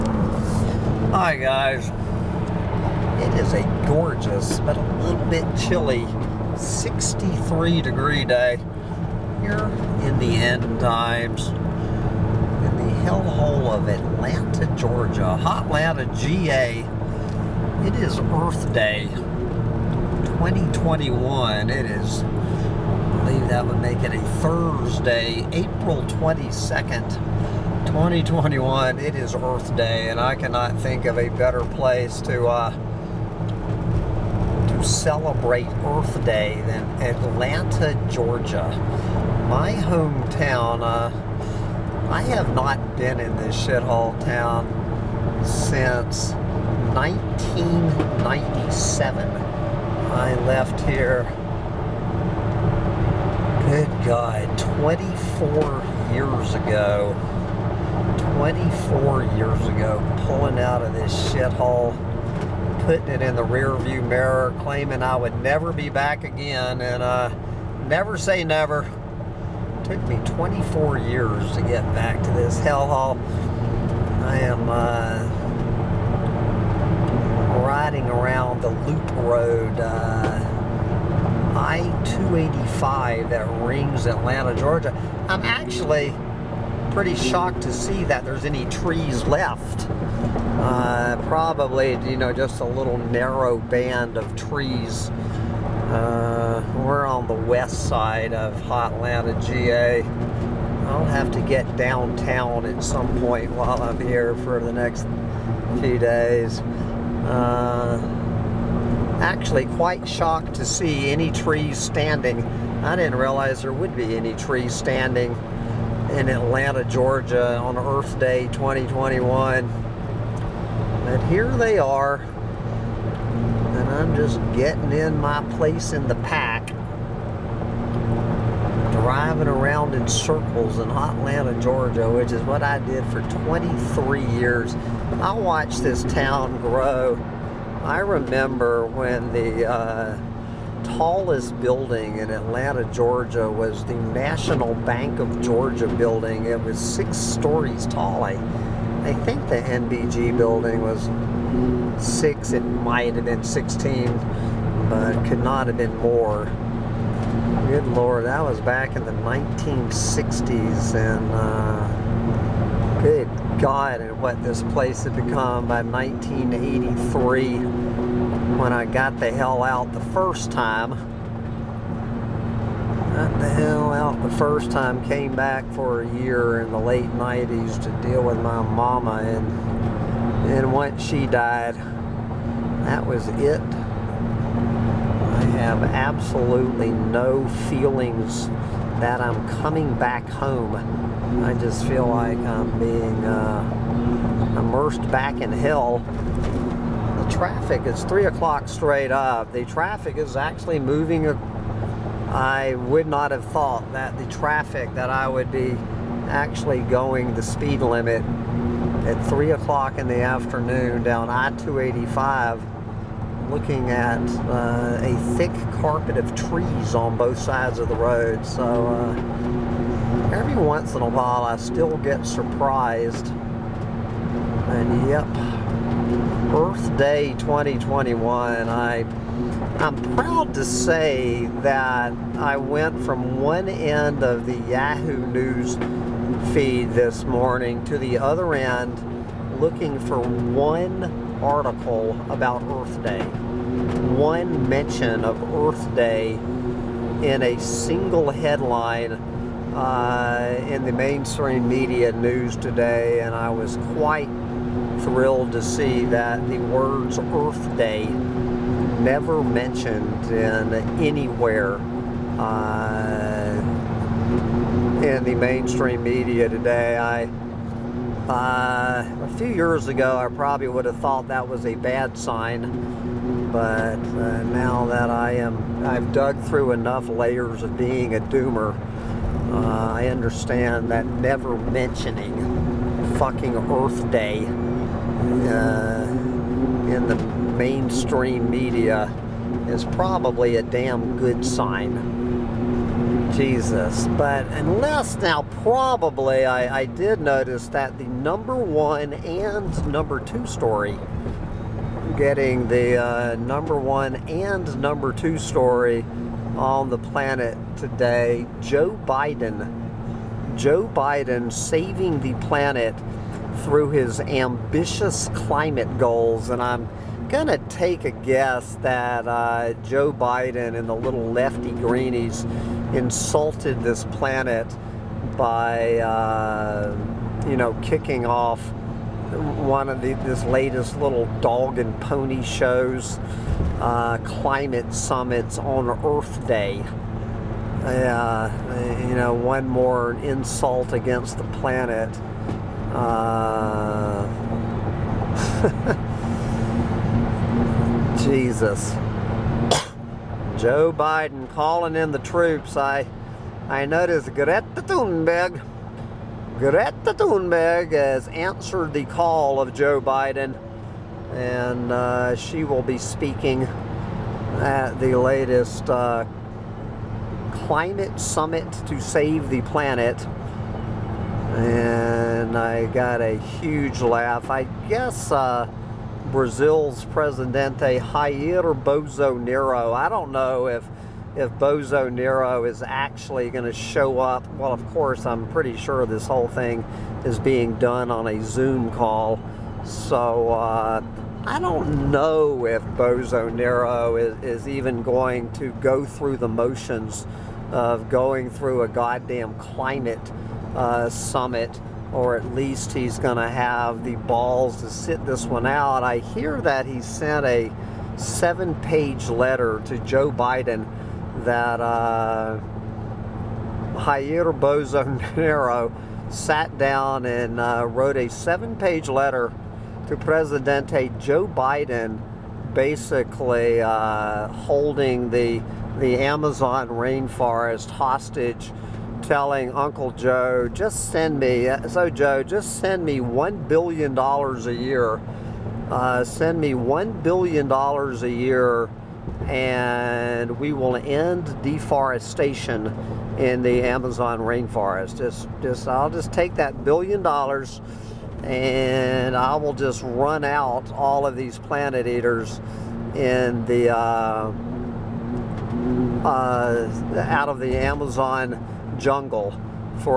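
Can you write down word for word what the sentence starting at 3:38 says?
So uh, every once in a while I still get surprised.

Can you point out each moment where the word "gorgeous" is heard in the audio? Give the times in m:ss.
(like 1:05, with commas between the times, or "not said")
0:03.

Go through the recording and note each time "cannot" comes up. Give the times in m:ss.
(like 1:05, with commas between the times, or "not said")
0:30.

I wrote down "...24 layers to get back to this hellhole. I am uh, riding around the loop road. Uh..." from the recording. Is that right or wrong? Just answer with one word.
wrong.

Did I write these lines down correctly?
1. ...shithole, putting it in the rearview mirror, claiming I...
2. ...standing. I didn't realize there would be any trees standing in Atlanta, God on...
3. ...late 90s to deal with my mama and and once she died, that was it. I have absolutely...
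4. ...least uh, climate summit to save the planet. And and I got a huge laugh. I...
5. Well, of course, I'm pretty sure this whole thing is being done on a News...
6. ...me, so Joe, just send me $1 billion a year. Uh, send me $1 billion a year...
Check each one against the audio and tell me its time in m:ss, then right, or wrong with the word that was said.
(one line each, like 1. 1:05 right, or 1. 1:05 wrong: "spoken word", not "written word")
1. 1:01 right
2. 1:51 wrong: "Georgia", not "God"
3. 2:56 right
4. 6:05 wrong: "latest", not "least"
5. 6:24 wrong: "Zoom", not "News"
6. 7:11 right.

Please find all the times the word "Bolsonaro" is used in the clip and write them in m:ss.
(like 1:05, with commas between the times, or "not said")
6:32, 6:54.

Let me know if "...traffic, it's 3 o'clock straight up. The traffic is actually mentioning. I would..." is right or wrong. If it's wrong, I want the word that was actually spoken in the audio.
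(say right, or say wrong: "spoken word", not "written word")
wrong: "moving", not "mentioning".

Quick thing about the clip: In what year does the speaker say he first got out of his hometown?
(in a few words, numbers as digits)
1983.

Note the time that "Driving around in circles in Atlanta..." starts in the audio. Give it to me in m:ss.
2:08.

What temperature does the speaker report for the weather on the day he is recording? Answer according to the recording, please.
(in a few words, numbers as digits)
63 degrees.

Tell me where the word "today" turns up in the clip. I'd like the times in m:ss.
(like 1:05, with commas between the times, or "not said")
4:12, 4:26, 5:07.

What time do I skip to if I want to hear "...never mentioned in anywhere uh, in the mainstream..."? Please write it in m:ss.
4:19.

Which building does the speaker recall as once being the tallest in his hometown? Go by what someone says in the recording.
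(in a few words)
National Bank of Georgia building.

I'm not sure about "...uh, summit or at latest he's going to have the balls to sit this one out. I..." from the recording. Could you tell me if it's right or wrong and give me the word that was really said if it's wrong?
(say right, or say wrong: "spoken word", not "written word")
wrong: "least", not "latest".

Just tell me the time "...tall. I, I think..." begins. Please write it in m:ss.
2:27.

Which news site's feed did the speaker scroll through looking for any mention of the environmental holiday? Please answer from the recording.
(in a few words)
Yahoo News.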